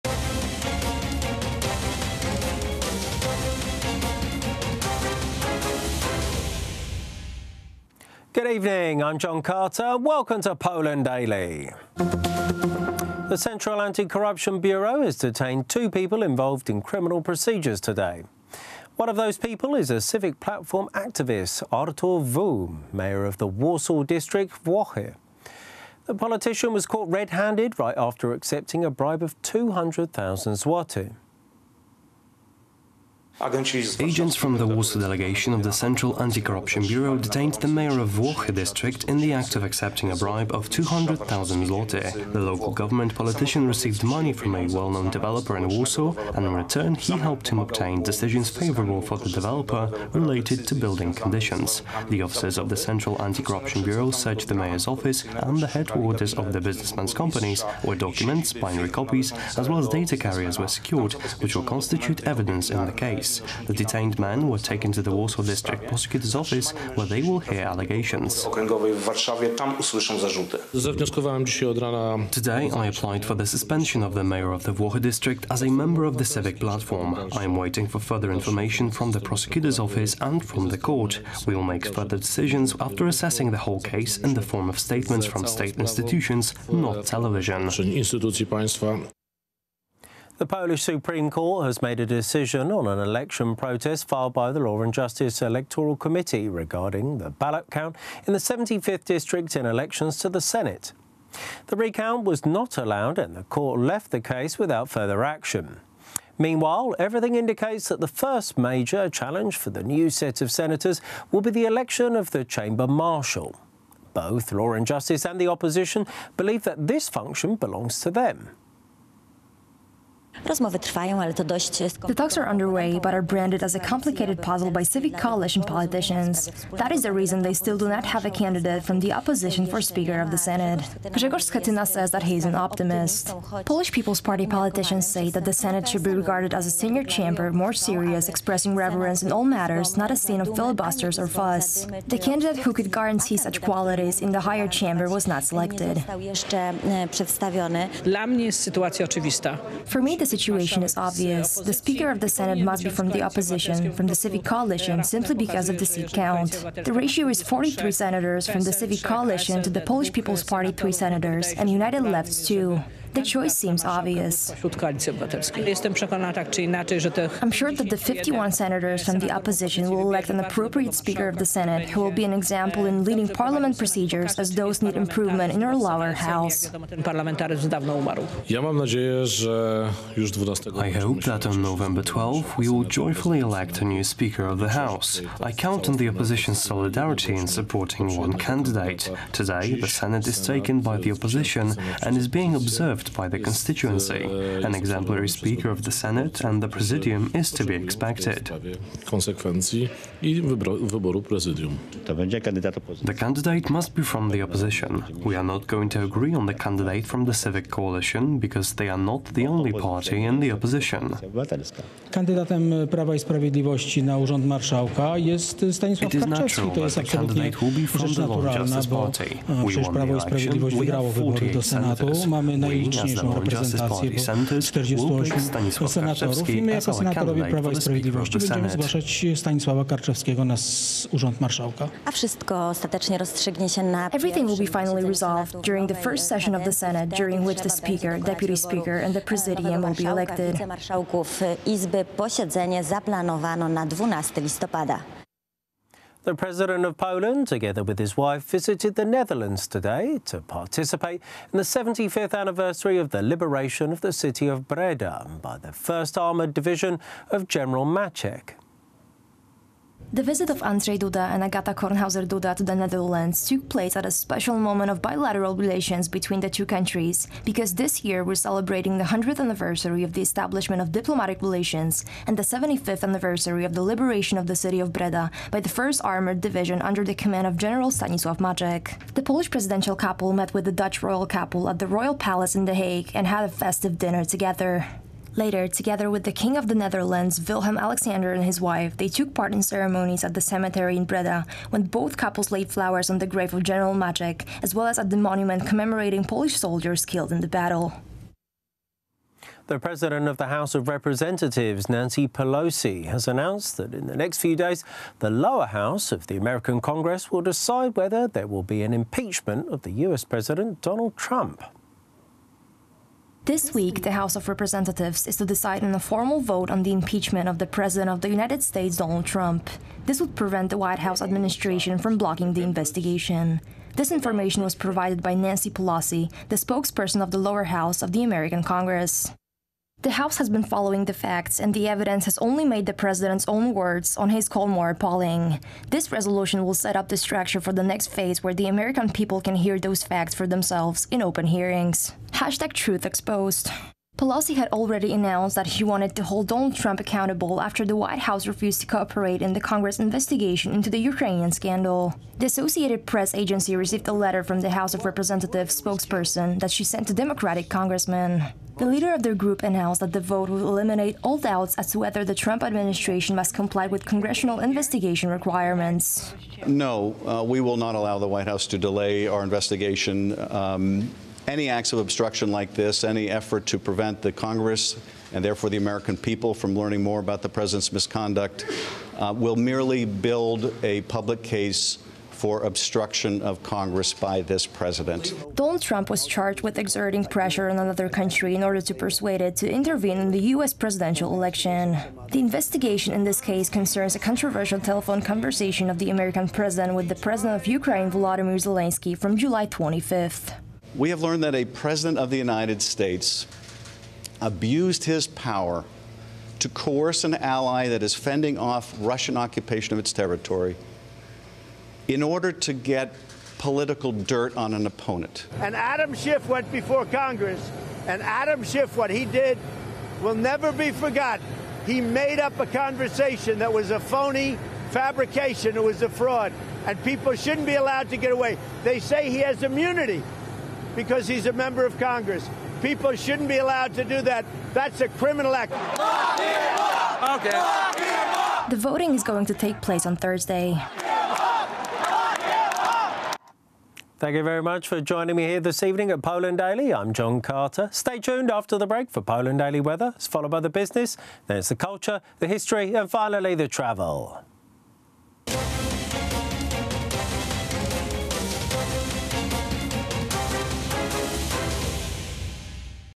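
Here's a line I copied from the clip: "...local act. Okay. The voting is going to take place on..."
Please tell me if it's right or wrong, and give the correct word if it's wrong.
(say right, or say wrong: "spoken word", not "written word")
wrong: "criminal", not "local".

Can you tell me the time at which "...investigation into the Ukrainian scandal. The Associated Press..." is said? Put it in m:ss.
5:49.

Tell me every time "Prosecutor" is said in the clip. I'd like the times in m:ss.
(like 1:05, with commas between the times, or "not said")
1:05, 1:19.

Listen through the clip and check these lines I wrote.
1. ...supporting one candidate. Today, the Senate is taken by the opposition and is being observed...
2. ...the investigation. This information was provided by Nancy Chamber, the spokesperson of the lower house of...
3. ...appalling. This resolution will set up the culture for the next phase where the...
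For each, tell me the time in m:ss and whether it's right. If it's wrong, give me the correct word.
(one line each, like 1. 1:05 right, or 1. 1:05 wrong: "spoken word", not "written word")
1. 3:07 right
2. 5:22 wrong: "Pelosi", not "Chamber"
3. 5:34 wrong: "structure", not "culture".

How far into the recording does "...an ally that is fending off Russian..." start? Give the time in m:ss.
6:47.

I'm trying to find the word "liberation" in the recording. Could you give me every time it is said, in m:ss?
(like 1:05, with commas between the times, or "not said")
4:13, 4:33.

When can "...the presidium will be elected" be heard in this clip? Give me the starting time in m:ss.
3:59.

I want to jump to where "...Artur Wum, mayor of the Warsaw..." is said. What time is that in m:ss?
0:21.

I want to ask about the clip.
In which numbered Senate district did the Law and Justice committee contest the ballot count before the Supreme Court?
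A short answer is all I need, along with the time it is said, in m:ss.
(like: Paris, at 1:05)
75th, at 1:38.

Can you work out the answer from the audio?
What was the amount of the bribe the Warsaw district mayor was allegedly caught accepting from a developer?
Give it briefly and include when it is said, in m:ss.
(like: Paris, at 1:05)
200,000 złoty, at 0:29.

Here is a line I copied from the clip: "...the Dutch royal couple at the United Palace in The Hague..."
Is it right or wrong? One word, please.
wrong.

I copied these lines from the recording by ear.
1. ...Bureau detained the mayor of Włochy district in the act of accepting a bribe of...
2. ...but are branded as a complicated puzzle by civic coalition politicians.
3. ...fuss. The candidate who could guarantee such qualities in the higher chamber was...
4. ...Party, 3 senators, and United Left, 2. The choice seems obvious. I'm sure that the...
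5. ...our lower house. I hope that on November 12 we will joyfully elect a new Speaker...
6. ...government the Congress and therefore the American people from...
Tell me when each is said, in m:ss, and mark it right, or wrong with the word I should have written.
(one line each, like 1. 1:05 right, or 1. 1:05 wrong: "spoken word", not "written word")
1. 0:36 right
2. 2:02 right
3. 2:21 right
4. 2:40 right
5. 2:55 right
6. 6:13 wrong: "prevent", not "government".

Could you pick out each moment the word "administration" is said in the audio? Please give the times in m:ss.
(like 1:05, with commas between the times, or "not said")
5:21, 6:02.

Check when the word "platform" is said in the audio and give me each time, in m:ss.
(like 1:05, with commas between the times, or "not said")
0:20, 1:16.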